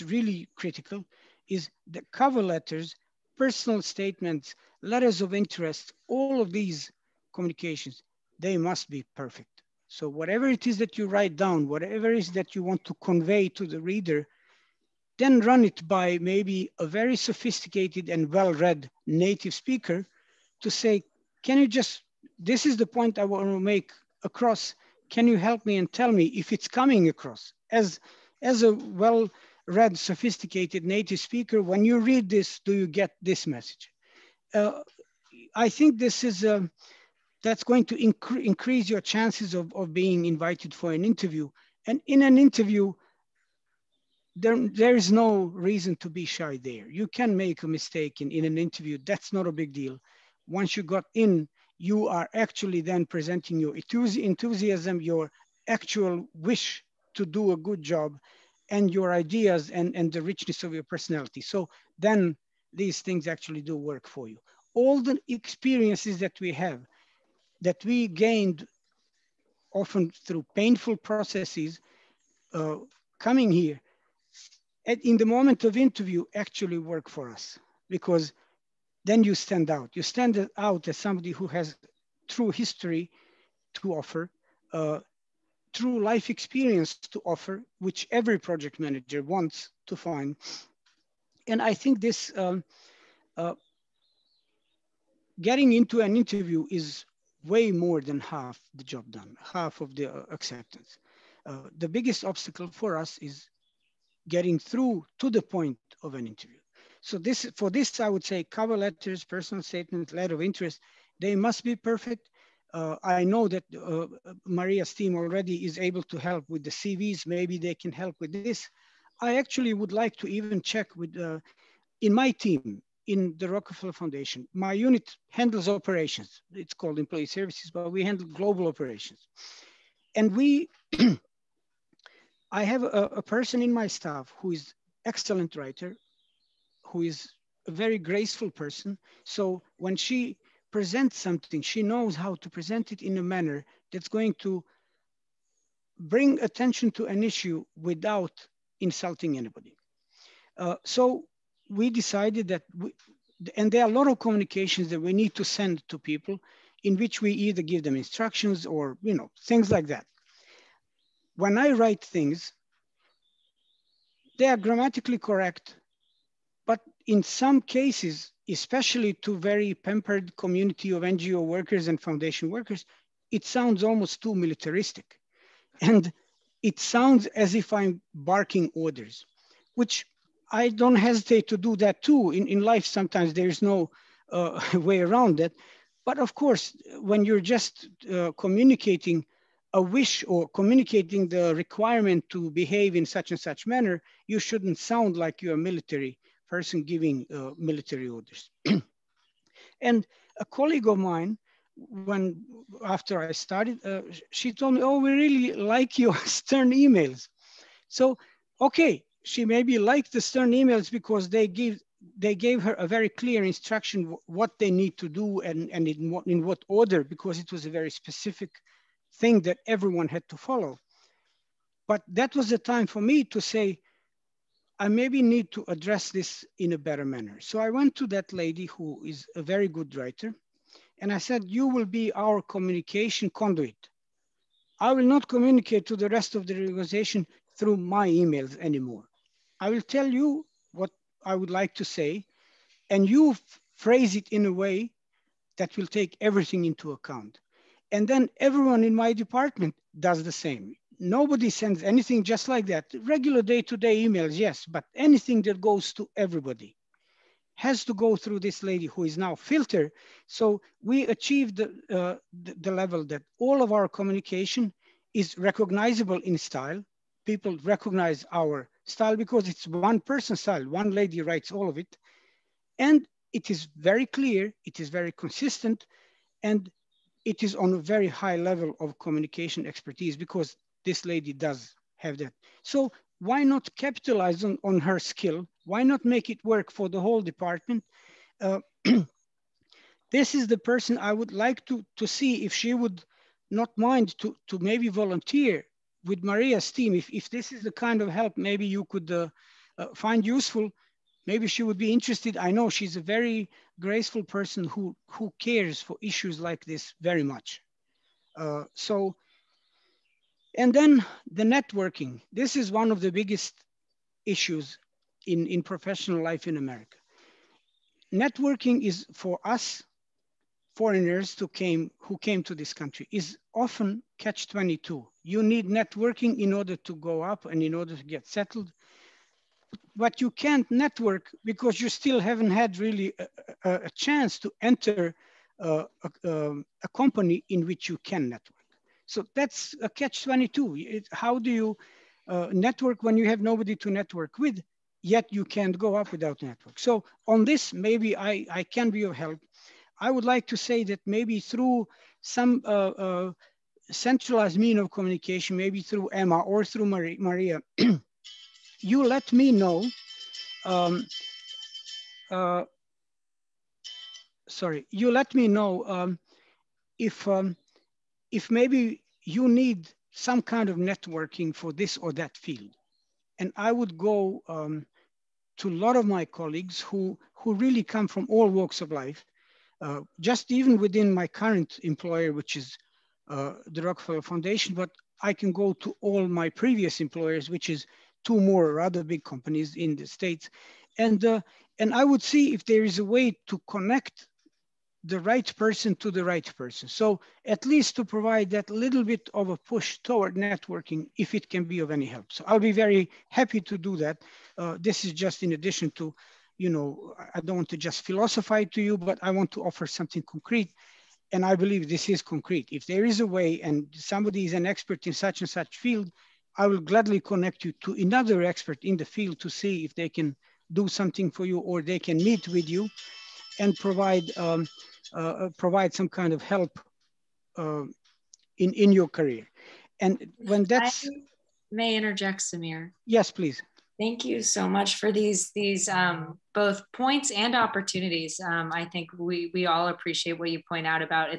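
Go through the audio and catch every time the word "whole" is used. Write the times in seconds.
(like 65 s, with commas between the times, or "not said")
286 s.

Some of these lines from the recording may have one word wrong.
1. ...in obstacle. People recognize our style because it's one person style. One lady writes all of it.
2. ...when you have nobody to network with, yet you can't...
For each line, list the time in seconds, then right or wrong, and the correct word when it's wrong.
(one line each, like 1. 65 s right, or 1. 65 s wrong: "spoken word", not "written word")
1. 266 s wrong: "style", not "obstacle"
2. 343 s right.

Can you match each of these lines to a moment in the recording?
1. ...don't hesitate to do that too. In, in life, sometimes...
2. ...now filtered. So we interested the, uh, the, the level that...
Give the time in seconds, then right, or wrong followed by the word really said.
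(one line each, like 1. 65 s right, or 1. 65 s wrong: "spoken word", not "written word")
1. 180 s right
2. 259 s wrong: "achieved", not "interested".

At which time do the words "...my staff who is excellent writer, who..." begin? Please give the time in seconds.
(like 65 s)
133 s.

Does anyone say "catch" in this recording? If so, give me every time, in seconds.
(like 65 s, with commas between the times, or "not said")
324 s, 339 s.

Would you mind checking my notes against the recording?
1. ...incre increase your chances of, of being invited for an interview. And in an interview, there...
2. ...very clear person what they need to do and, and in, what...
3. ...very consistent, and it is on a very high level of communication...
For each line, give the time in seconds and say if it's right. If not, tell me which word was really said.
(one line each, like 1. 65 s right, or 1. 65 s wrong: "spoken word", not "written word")
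1. 37 s right
2. 212 s wrong: "instruction", not "person"
3. 274 s right.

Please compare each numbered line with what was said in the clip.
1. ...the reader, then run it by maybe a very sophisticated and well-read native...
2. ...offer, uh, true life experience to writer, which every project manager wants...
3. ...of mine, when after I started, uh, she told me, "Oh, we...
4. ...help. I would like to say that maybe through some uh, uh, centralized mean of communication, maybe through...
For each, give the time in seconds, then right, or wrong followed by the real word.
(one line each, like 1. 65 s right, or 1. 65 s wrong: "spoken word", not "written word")
1. 13 s right
2. 83 s wrong: "offer", not "writer"
3. 200 s right
4. 349 s right.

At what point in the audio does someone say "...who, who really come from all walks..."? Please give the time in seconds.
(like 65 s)
376 s.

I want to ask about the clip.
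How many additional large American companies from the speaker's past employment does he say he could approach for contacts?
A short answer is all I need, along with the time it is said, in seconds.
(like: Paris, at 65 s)
2, at 388 s.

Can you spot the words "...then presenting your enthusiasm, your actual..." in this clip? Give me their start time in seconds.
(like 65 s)
52 s.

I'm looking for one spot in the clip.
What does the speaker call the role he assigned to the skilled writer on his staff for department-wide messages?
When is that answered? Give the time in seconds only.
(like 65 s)
232 s.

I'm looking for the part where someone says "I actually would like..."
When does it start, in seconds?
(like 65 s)
119 s.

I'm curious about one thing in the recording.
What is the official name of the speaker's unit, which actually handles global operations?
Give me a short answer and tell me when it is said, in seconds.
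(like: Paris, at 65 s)
employee services, at 126 s.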